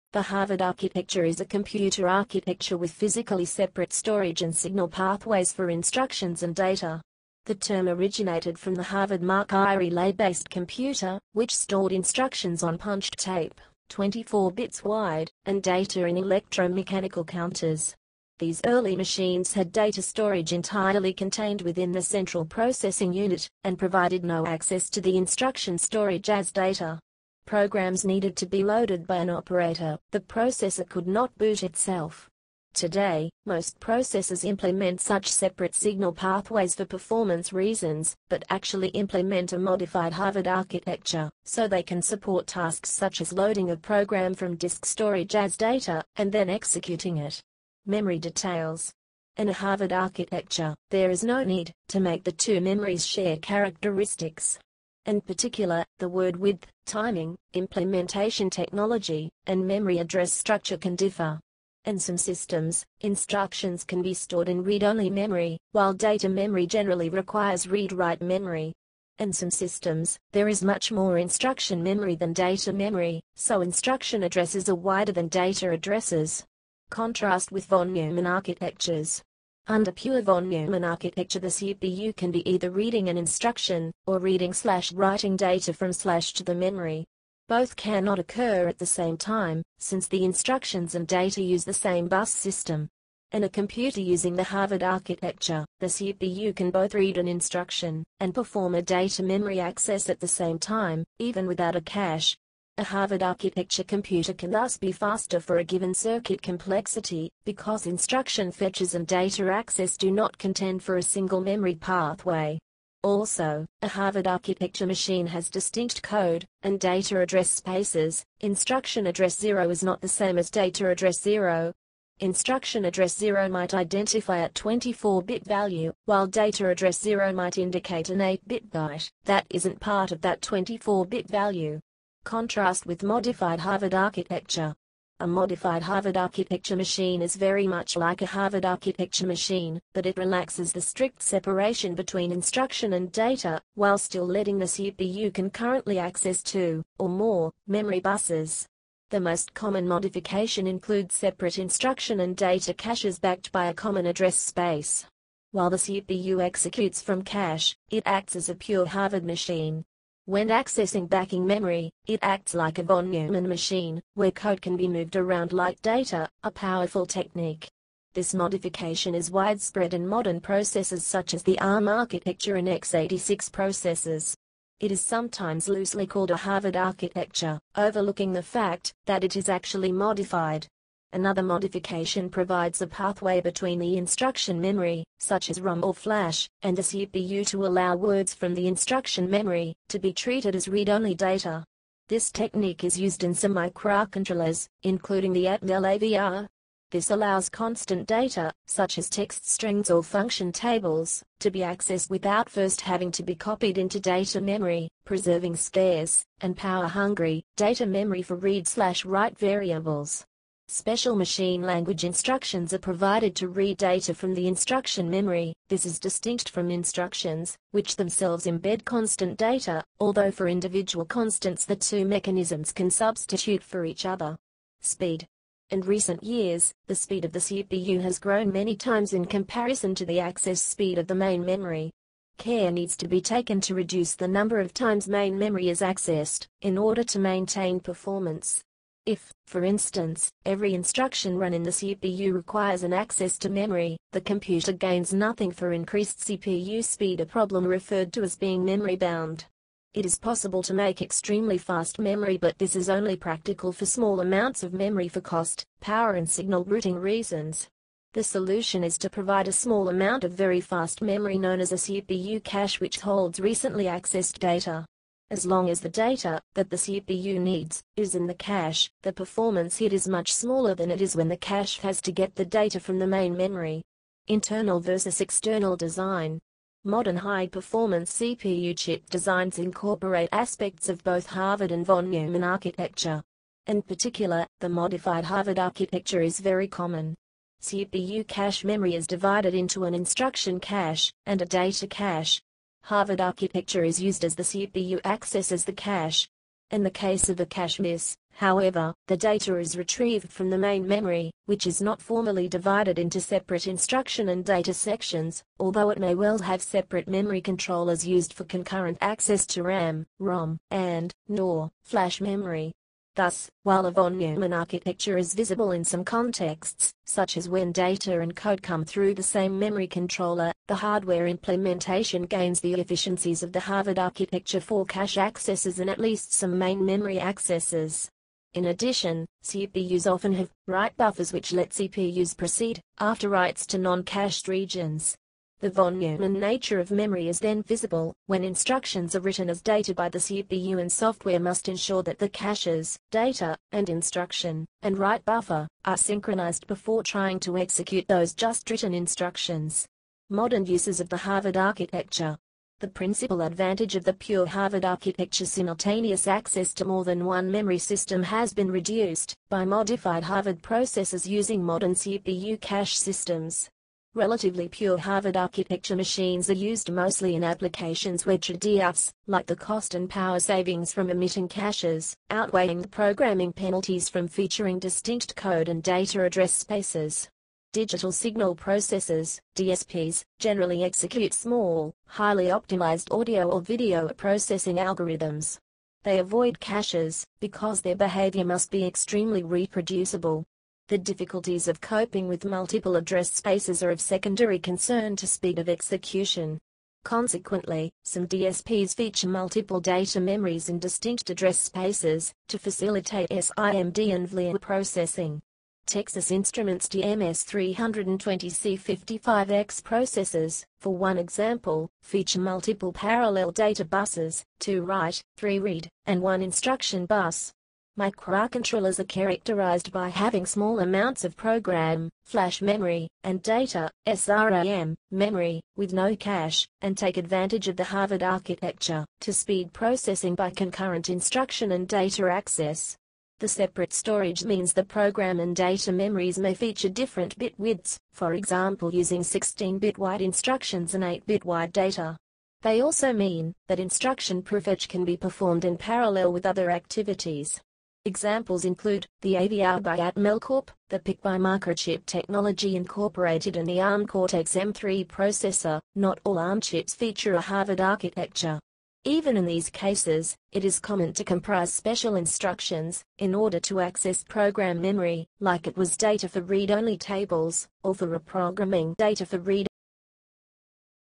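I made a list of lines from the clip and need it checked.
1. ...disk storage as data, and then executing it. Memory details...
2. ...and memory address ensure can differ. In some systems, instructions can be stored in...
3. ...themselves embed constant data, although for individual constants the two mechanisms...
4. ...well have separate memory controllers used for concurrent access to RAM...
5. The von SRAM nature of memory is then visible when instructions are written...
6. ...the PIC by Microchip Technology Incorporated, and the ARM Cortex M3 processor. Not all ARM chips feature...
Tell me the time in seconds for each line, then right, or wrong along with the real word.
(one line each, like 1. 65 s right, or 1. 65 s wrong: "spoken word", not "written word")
1. 44 s right
2. 59 s wrong: "structure", not "ensure"
3. 217 s right
4. 306 s right
5. 335 s wrong: "Neumann", not "SRAM"
6. 450 s right.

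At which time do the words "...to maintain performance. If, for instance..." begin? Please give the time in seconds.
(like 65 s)
237 s.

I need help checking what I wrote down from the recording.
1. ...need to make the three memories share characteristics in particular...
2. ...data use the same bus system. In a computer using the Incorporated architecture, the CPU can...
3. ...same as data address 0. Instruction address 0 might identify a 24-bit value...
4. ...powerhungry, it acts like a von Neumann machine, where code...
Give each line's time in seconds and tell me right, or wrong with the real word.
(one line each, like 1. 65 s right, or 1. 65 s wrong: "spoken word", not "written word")
1. 51 s wrong: "two", not "three"
2. 91 s wrong: "Harvard", not "Incorporated"
3. 120 s right
4. 161 s wrong: "memory", not "powerhungry".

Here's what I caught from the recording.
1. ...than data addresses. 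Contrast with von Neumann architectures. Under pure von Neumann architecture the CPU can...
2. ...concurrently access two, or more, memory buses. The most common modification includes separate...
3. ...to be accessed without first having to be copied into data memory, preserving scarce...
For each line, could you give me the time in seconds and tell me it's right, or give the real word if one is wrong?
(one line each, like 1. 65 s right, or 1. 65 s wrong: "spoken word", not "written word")
1. 75 s right
2. 145 s right
3. 201 s right.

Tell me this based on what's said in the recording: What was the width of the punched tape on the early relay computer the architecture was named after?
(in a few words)
24 bits.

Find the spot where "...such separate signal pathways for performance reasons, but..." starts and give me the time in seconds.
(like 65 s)
35 s.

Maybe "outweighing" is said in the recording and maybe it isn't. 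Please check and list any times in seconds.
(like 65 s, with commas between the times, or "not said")
372 s.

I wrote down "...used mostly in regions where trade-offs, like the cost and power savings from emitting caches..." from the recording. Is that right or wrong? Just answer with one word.
wrong.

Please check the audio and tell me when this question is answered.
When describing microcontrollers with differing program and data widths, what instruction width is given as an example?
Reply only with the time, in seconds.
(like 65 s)
439 s.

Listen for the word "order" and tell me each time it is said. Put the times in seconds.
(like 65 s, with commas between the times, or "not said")
236 s, 463 s.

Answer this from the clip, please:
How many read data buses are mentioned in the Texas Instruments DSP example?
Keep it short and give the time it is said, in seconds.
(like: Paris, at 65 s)
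3, at 415 s.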